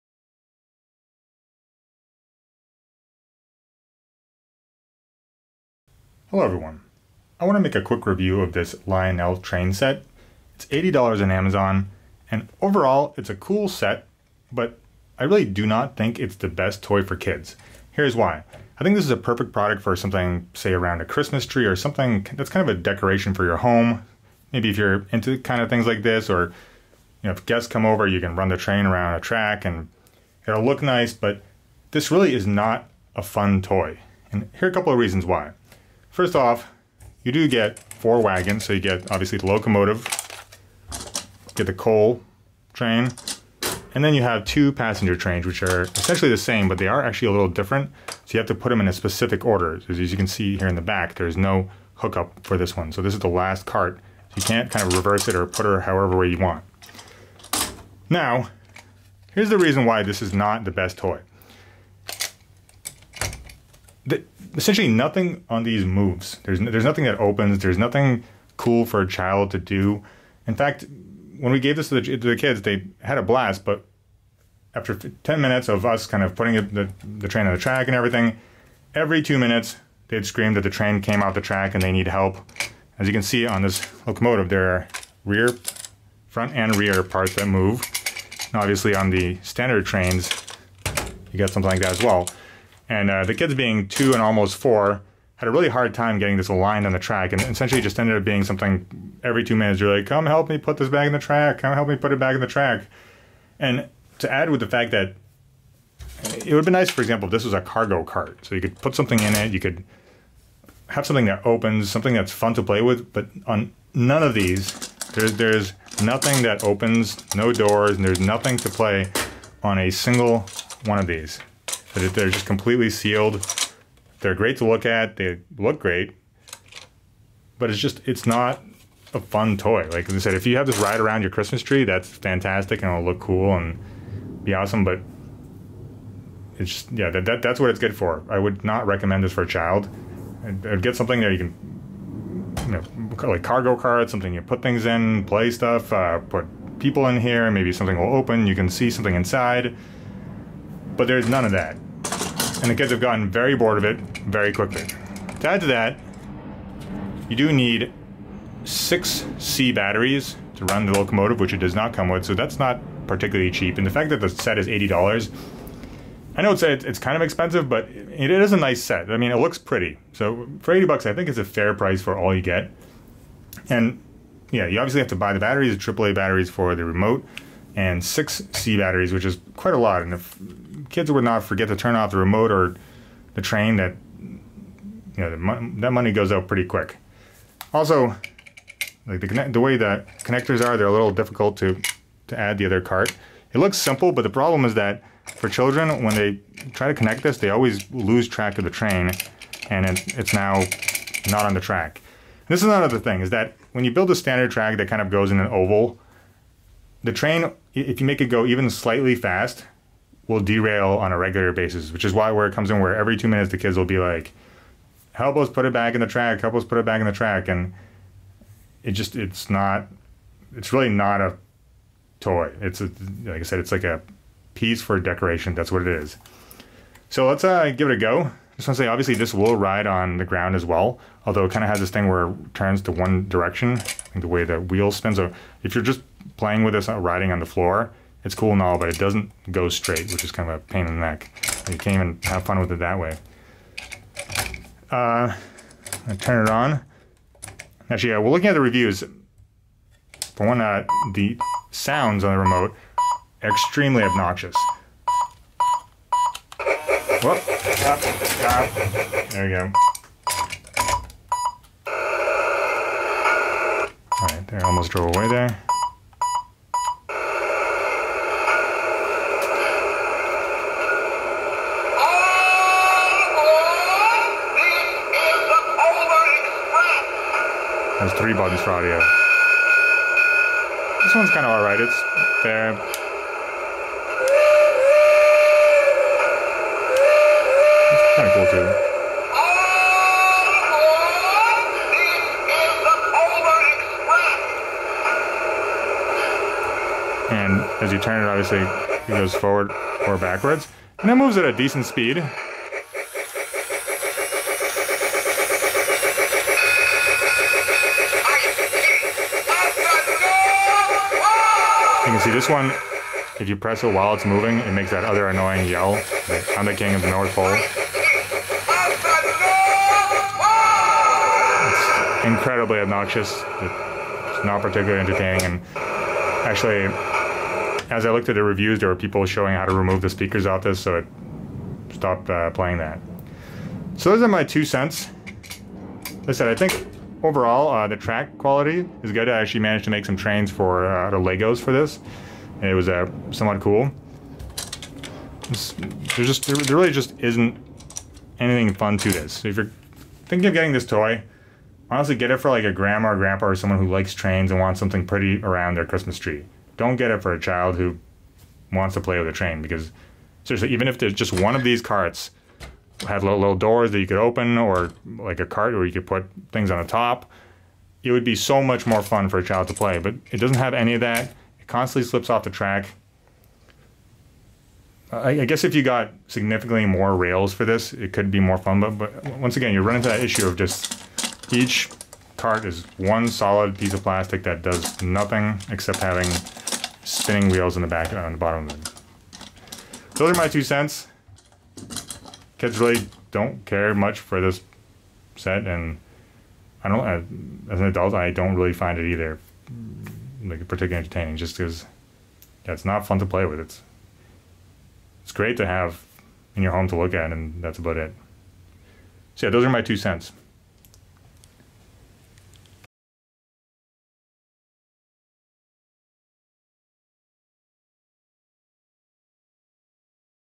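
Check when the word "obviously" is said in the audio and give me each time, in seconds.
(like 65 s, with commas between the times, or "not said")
39 s, 88 s, 174 s, 228 s, 298 s.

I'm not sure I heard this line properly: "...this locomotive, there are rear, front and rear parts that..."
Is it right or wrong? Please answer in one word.
right.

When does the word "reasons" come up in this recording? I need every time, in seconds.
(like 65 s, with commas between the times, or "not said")
34 s, 59 s.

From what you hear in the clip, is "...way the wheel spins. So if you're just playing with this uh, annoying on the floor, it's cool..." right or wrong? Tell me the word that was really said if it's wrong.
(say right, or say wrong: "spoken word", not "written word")
wrong: "riding", not "annoying".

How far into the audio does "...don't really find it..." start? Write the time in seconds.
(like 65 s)
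398 s.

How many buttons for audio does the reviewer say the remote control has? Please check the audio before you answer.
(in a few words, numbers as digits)
3.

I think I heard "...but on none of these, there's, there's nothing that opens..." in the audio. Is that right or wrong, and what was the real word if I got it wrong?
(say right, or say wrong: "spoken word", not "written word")
right.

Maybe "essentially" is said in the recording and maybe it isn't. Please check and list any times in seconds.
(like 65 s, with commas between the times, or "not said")
45 s, 64 s, 97 s.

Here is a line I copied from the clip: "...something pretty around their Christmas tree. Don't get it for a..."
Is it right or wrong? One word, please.
right.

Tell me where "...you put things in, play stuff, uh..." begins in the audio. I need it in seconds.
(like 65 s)
144 s.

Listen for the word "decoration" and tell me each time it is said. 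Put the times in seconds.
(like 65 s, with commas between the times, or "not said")
22 s, 224 s.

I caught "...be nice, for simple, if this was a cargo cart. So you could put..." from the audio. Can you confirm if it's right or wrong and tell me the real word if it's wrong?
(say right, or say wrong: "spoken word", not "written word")
wrong: "example", not "simple".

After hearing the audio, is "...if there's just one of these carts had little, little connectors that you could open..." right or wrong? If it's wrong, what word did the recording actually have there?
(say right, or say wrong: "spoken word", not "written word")
wrong: "doors", not "connectors".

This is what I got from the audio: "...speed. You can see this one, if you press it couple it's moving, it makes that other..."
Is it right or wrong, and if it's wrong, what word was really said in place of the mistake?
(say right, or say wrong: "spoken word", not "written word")
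wrong: "while", not "couple".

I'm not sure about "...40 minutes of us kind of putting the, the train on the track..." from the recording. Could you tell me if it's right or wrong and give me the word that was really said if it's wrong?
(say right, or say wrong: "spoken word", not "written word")
wrong: "10", not "40".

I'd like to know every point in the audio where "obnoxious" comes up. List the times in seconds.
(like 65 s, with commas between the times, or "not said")
254 s, 322 s.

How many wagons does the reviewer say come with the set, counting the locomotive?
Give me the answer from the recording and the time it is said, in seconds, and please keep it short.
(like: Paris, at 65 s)
4, at 37 s.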